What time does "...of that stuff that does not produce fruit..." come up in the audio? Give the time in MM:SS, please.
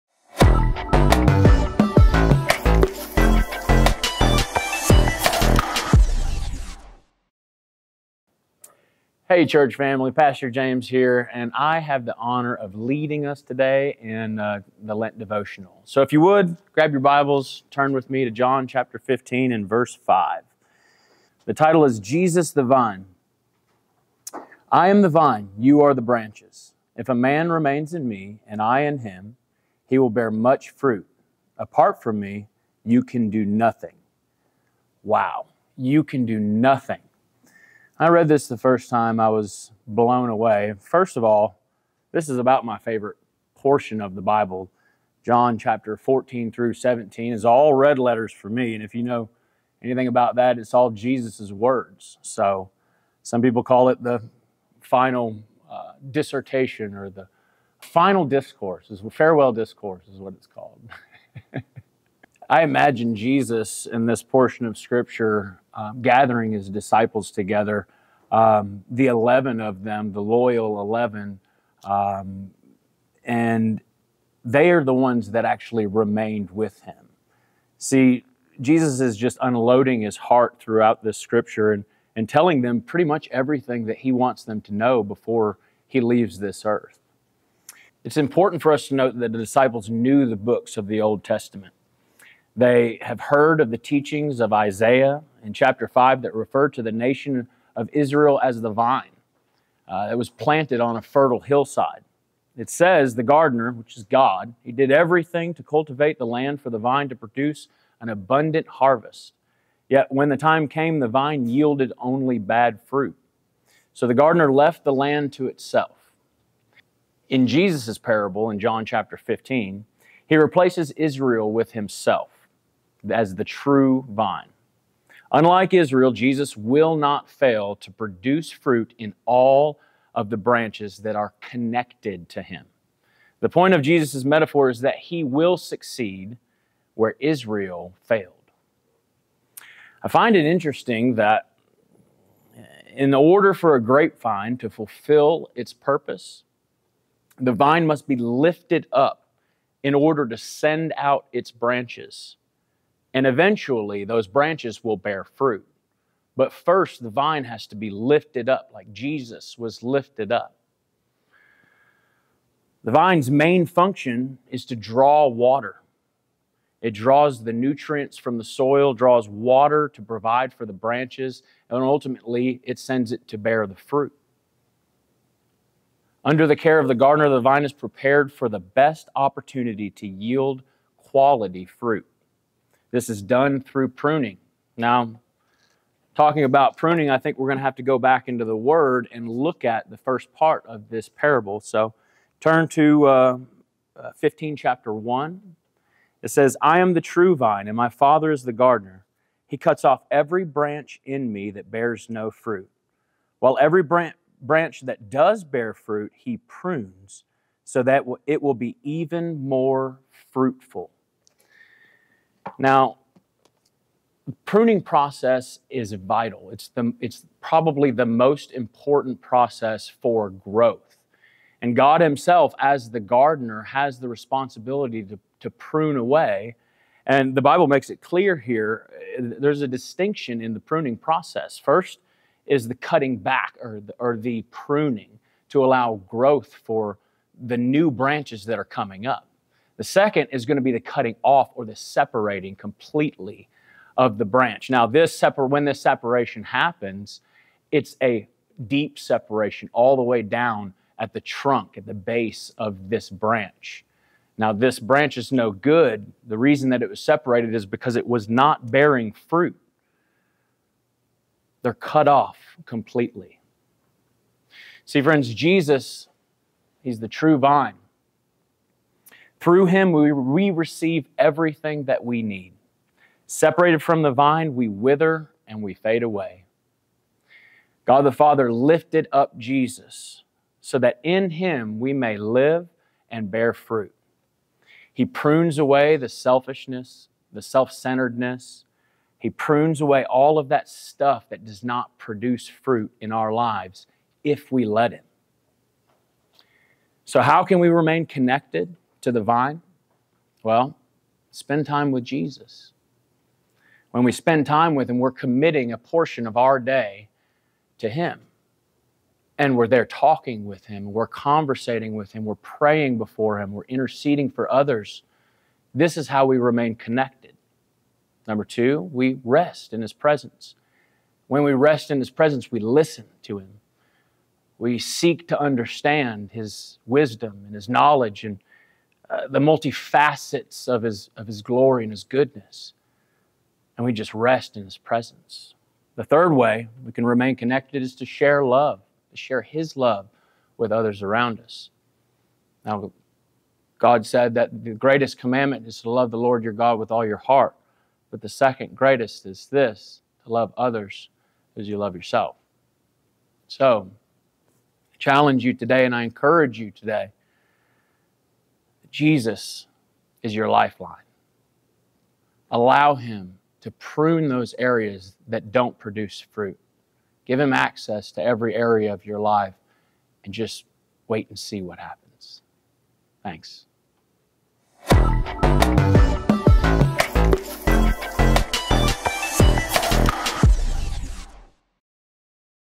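04:50.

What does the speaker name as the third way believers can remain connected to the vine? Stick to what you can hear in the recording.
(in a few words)
share his love.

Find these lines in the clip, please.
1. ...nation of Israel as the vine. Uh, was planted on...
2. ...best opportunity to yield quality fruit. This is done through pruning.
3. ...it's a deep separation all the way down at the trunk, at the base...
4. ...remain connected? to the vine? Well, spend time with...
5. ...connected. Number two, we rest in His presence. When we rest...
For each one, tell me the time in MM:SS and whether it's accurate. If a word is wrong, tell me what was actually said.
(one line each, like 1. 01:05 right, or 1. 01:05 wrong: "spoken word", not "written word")
1. 01:36 right
2. 02:58 right
3. 04:07 right
4. 04:57 right
5. 05:16 right.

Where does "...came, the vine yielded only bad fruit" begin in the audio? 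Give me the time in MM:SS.
01:50.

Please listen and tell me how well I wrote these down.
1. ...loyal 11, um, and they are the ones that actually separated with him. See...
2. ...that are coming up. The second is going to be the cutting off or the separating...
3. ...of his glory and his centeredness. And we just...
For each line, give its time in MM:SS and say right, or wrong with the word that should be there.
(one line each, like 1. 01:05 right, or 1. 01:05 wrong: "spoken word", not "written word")
1. 01:10 wrong: "remained", not "separated"
2. 03:58 right
3. 05:31 wrong: "goodness", not "centeredness".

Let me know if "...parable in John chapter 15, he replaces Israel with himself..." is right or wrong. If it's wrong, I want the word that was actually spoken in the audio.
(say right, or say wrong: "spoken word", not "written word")
right.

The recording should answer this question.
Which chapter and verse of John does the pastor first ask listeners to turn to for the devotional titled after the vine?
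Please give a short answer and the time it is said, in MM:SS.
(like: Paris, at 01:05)
John 15:5, at 00:18.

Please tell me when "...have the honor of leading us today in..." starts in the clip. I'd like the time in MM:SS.
00:11.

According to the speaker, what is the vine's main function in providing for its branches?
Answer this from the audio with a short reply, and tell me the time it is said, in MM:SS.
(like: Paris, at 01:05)
to draw water, at 02:44.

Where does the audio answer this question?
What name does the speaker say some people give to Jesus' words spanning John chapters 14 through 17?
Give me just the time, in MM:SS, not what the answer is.
00:59.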